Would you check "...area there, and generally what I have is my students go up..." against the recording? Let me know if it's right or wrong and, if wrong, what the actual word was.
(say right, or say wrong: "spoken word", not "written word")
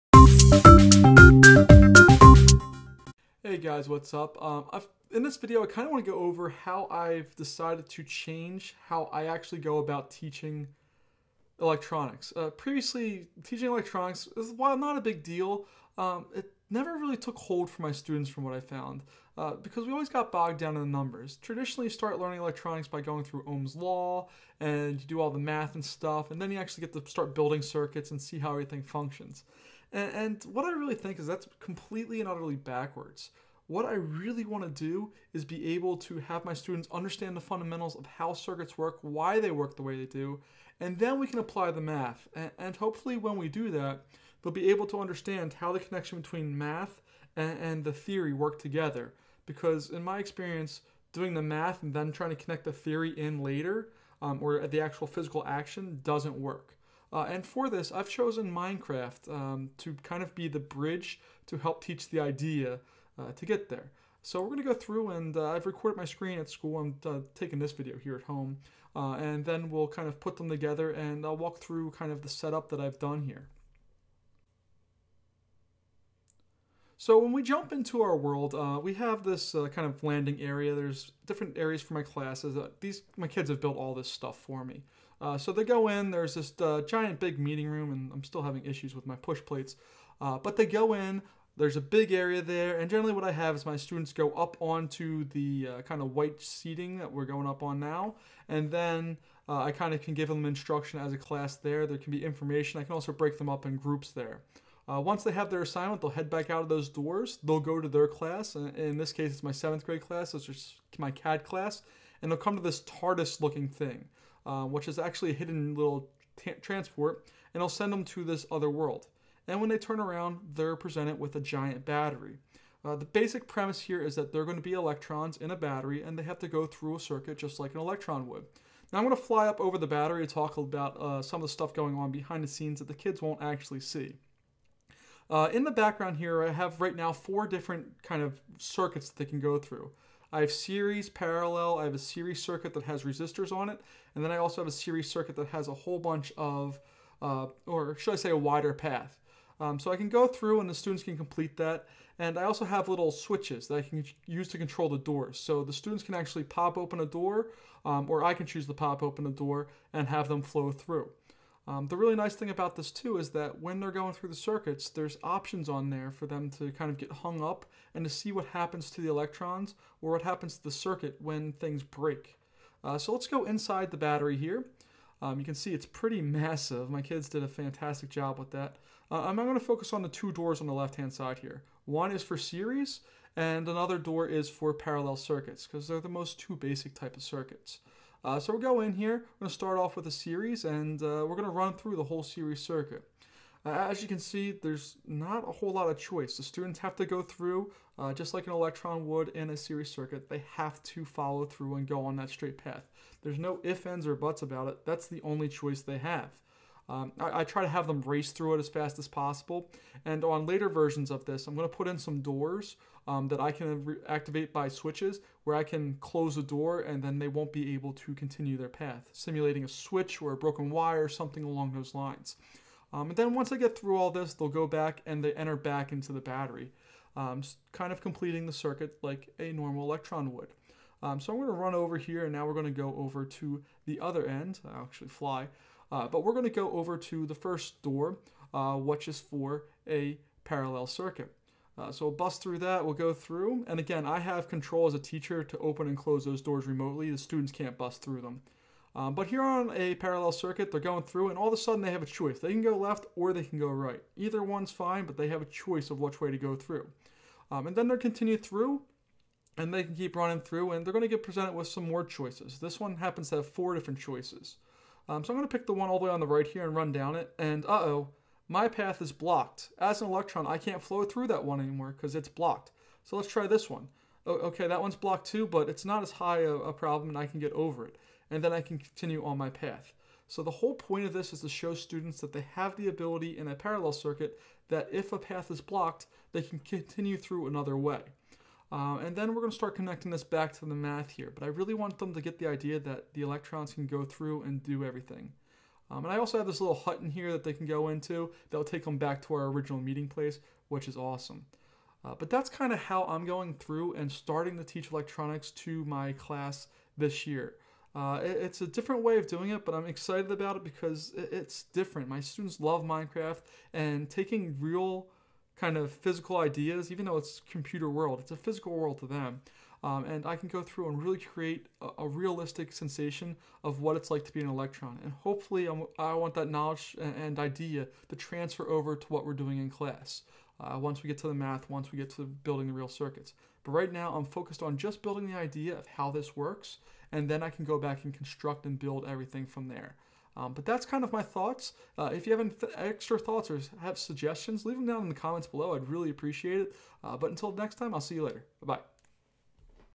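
right.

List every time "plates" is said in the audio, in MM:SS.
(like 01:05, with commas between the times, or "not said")
01:29.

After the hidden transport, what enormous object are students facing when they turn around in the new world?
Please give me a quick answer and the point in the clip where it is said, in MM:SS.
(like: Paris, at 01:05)
A giant battery, at 02:01.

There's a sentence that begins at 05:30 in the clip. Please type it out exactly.
Uh, once we get to the math, once we get to building the real circuits.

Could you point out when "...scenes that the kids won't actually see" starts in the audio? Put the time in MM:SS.
02:12.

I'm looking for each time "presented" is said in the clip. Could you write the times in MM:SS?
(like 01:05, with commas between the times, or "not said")
02:00, 04:21.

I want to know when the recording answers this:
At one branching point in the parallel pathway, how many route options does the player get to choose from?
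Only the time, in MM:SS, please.
04:23.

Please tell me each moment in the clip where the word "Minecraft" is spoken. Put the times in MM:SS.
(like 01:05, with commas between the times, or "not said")
00:58, 05:12.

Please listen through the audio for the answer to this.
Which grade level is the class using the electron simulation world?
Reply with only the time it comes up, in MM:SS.
01:49.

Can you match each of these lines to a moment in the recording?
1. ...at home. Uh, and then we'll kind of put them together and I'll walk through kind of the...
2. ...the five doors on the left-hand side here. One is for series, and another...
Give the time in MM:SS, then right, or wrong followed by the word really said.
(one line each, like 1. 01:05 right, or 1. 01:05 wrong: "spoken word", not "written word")
1. 01:08 right
2. 03:00 wrong: "two", not "five".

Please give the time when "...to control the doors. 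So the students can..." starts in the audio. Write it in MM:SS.
02:34.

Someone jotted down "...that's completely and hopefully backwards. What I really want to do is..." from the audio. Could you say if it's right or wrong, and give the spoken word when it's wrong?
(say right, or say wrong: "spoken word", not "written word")
wrong: "utterly", not "hopefully".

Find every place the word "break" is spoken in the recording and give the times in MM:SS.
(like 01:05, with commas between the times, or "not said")
01:43, 02:51.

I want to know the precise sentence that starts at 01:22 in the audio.
Uh, these My kids have built all this stuff for me.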